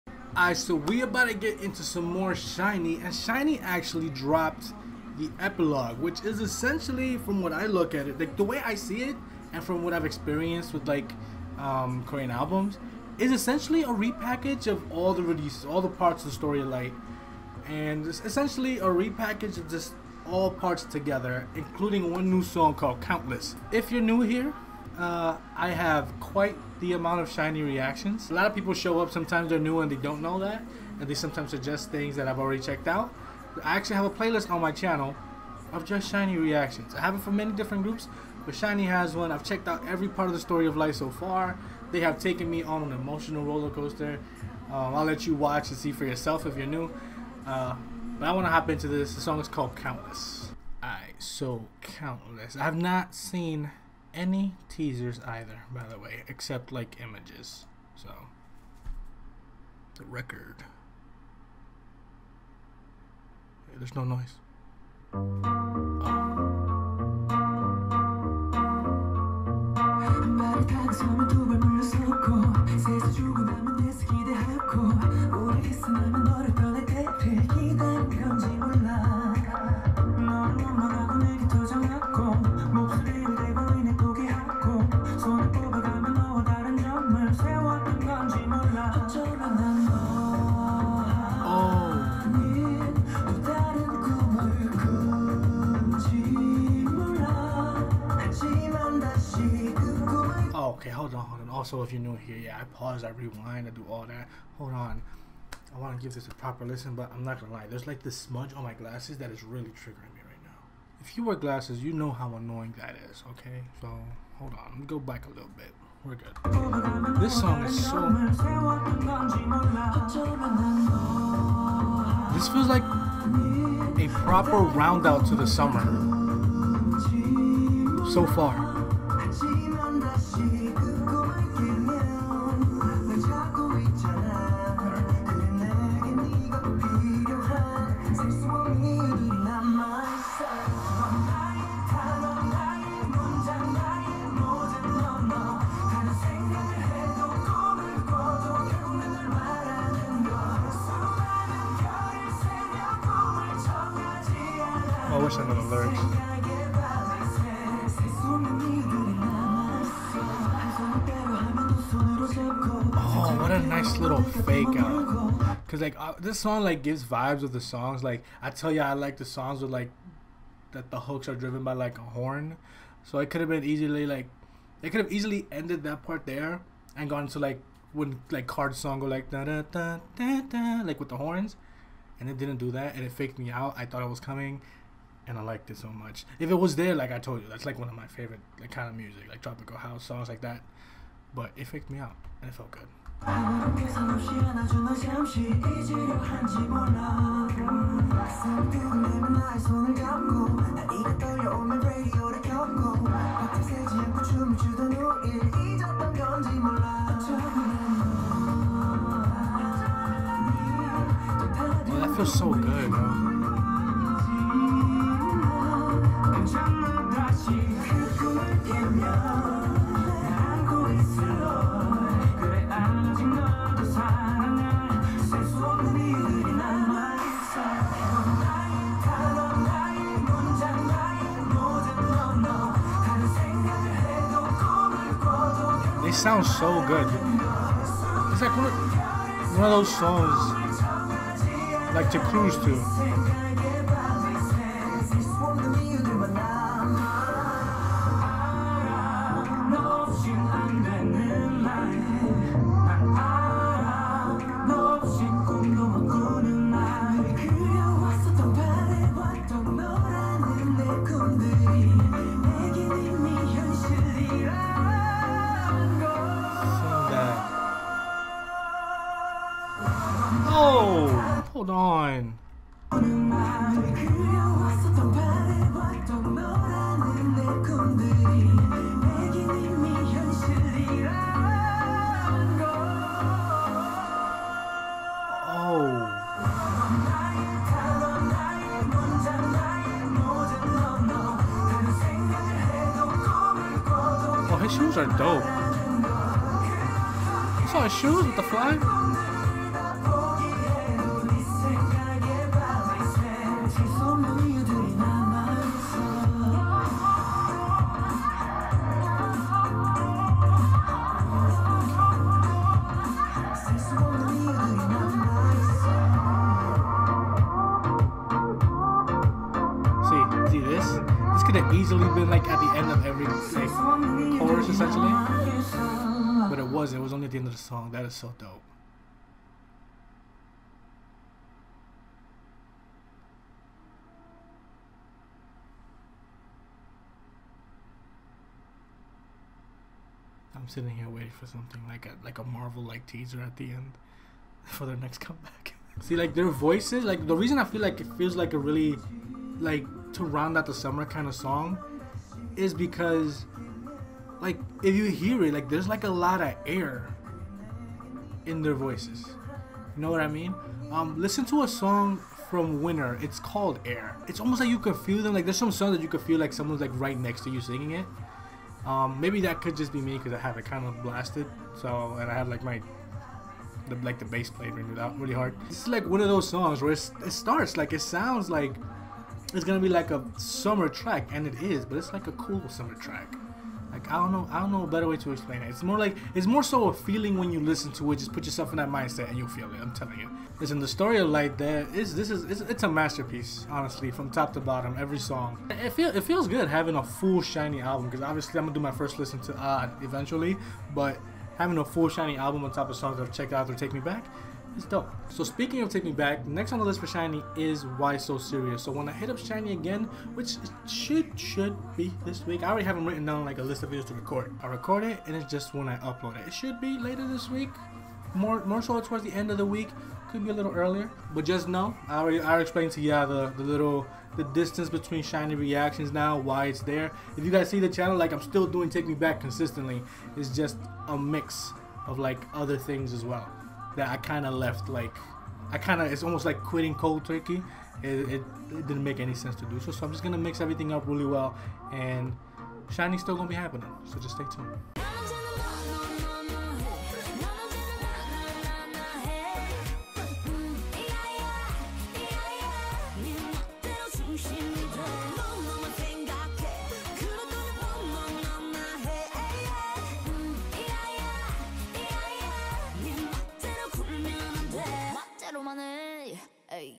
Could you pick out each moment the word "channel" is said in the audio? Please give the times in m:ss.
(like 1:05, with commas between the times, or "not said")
0:34, 7:07.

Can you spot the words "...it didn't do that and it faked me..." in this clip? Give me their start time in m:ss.
3:02.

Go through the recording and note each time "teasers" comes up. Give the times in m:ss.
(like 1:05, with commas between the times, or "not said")
0:54, 5:43.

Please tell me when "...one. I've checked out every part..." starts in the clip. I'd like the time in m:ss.
0:39.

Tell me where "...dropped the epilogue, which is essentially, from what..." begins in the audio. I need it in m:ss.
0:04.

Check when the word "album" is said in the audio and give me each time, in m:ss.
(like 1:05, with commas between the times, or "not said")
0:12, 6:37, 6:42.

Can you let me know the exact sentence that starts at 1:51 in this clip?
If you wear glasses, you know how annoying that is, okay?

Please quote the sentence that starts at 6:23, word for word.
Like I don't know, I don't know a better way to explain it.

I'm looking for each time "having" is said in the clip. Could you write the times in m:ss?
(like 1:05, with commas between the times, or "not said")
6:36, 6:41.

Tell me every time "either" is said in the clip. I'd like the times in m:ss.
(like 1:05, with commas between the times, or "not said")
0:55.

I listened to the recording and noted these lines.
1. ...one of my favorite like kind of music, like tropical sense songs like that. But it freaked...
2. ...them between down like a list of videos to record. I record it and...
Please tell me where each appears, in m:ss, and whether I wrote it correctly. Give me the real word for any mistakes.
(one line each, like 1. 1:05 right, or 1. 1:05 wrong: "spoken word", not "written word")
1. 3:07 wrong: "house", not "sense"
2. 6:52 wrong: "written", not "between".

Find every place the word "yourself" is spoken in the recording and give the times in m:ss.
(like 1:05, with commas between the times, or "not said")
0:46, 6:28.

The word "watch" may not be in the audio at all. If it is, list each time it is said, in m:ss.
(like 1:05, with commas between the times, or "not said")
0:45.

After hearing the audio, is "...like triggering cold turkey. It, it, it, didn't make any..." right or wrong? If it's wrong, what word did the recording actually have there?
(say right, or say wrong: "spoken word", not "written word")
wrong: "quitting", not "triggering".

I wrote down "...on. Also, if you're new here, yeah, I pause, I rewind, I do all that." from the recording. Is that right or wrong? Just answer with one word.
right.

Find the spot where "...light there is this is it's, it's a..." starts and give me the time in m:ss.
6:31.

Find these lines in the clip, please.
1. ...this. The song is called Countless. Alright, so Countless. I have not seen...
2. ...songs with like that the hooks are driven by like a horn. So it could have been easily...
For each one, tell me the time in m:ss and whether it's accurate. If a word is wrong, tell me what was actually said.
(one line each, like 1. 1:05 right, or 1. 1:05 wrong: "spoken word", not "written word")
1. 0:48 right
2. 2:49 right.